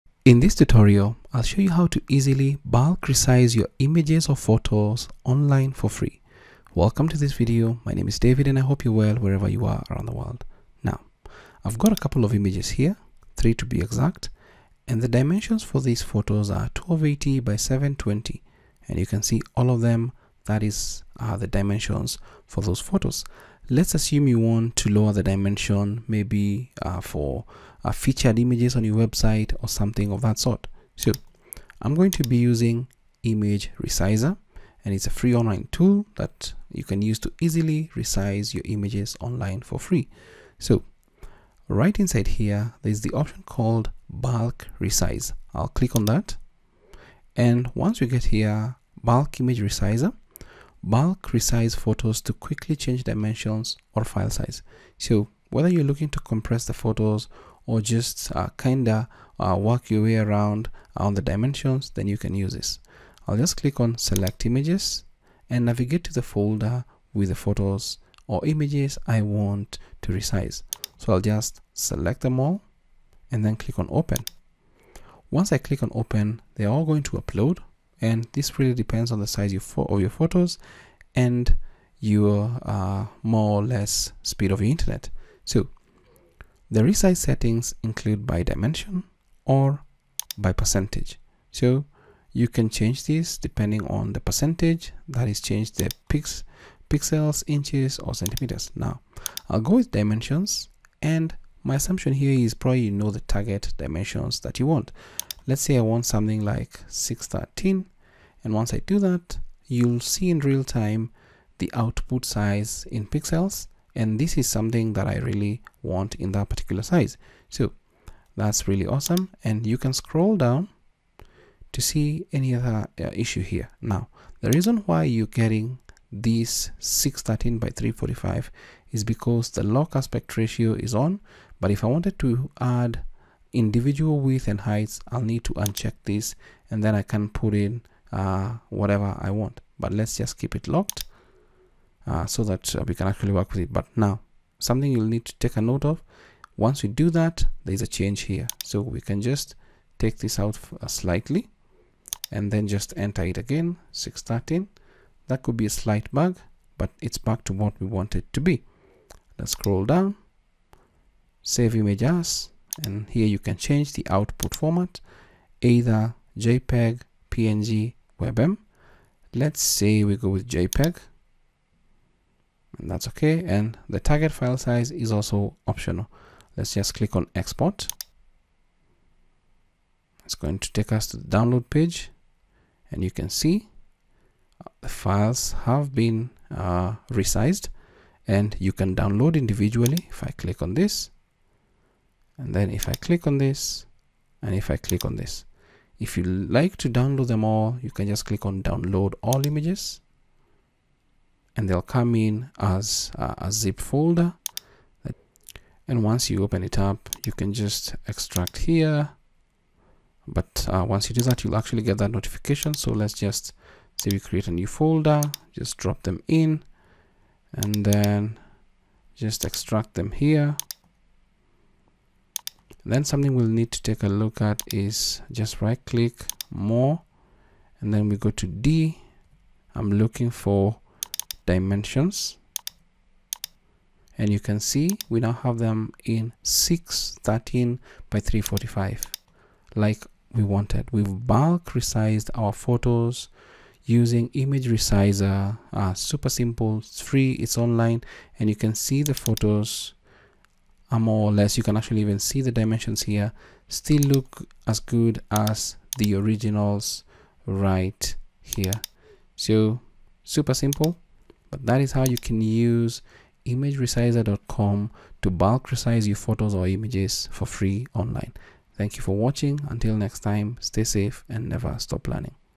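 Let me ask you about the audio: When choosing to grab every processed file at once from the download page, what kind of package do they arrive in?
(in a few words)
zip folder.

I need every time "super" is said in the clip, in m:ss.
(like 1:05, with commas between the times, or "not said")
4:05, 4:20.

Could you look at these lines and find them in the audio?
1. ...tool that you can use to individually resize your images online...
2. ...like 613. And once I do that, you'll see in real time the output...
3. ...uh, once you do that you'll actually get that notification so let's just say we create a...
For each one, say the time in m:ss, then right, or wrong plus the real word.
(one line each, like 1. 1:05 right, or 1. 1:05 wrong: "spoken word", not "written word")
1. 0:35 wrong: "easily", not "individually"
2. 1:46 right
3. 3:30 right.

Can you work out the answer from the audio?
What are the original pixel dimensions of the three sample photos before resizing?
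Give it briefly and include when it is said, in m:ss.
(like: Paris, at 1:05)
1280 by 720, at 0:16.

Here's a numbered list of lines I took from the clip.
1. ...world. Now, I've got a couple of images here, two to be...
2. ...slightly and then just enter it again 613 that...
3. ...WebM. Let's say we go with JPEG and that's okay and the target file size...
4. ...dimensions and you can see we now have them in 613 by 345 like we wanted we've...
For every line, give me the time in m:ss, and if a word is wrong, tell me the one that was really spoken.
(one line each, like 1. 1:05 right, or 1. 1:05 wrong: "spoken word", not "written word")
1. 0:10 wrong: "three", not "two"
2. 2:30 right
3. 2:48 right
4. 3:51 right.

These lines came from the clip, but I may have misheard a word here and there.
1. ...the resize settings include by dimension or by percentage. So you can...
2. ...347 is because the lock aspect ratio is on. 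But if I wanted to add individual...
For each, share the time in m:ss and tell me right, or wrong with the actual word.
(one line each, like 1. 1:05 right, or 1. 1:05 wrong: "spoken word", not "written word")
1. 1:26 right
2. 2:07 wrong: "345", not "347".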